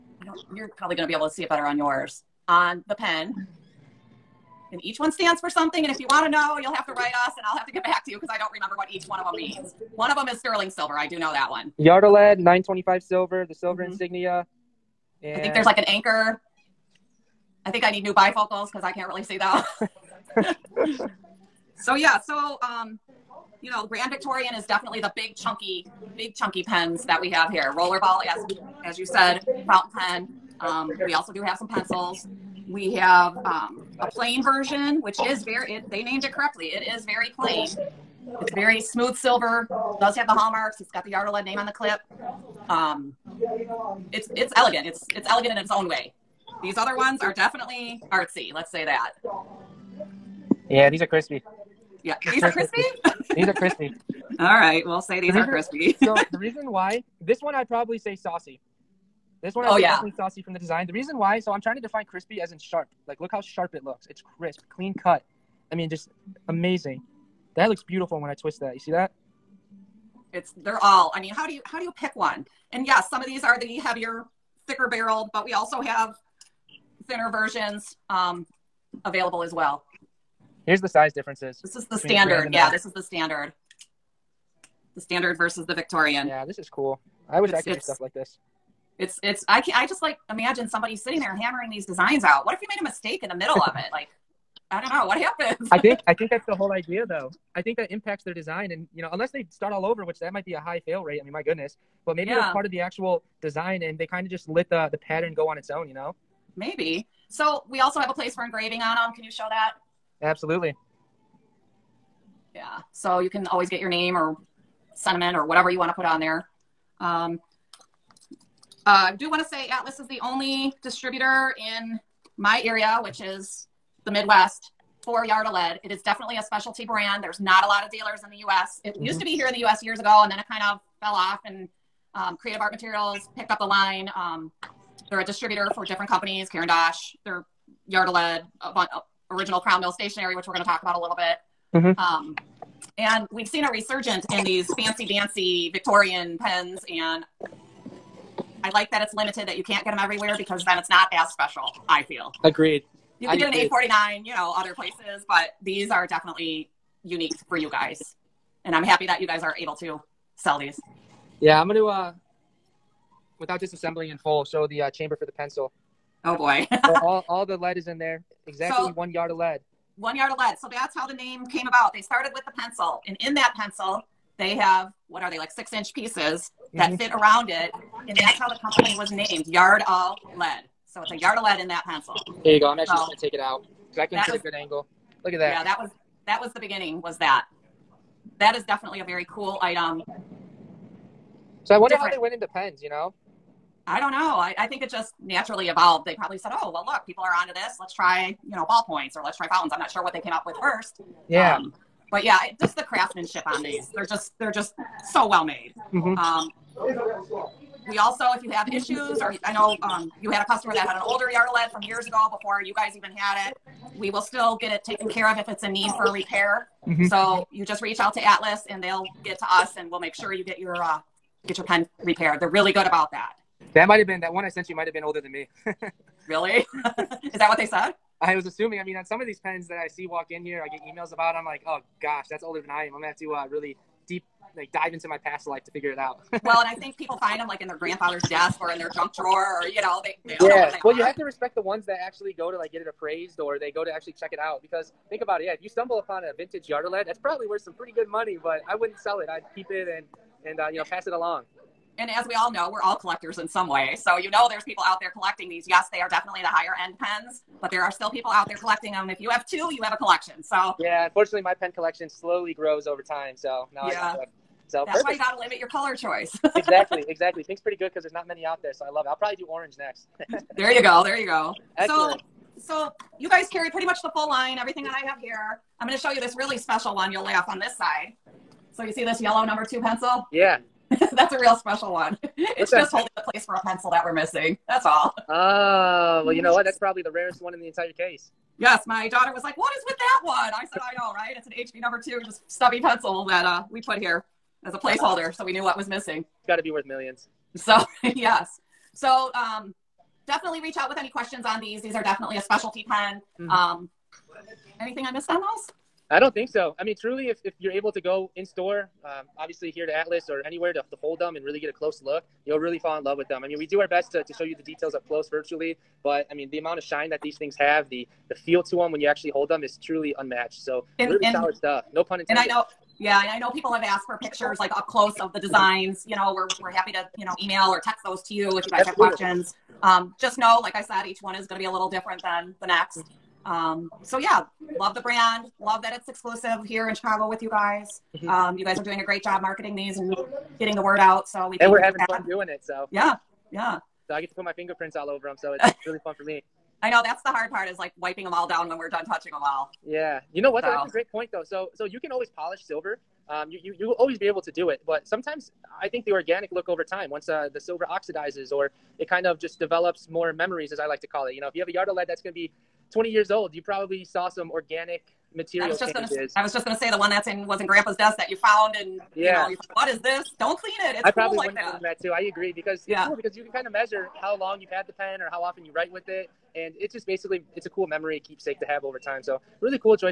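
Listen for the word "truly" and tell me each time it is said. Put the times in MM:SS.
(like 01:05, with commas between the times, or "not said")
05:06, 05:19.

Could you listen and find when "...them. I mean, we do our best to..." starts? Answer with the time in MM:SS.
05:13.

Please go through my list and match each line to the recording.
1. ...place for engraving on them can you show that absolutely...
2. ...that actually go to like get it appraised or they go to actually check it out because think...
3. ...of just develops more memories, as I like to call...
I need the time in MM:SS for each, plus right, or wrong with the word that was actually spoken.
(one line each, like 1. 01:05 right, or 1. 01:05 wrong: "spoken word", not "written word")
1. 01:48 right
2. 04:01 right
3. 05:59 right.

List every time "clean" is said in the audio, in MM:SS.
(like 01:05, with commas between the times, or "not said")
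01:04, 06:10.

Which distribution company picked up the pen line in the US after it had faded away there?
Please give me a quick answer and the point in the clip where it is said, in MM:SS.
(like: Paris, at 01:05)
Creative Art Materials, at 02:12.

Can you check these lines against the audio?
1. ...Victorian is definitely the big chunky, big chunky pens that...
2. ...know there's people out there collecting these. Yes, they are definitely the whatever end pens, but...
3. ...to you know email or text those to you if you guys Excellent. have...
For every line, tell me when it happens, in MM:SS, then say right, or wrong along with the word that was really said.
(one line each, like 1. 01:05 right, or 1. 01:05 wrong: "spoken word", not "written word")
1. 00:24 right
2. 04:14 wrong: "higher", not "whatever"
3. 05:26 wrong: "Absolutely", not "Excellent".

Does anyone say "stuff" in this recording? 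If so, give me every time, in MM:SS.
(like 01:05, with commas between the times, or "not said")
01:27, 05:21.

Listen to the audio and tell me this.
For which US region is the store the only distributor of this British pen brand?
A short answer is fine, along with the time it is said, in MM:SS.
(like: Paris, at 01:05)
the Midwest, at 02:04.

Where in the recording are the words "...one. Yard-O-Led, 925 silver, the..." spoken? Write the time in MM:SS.
00:11.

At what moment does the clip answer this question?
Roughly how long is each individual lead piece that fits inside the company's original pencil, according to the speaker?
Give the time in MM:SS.
02:55.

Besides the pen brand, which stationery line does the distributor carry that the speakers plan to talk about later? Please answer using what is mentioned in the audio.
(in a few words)
Crown Mill Stationery.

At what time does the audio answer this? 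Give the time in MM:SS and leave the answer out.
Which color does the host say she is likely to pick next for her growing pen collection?
04:29.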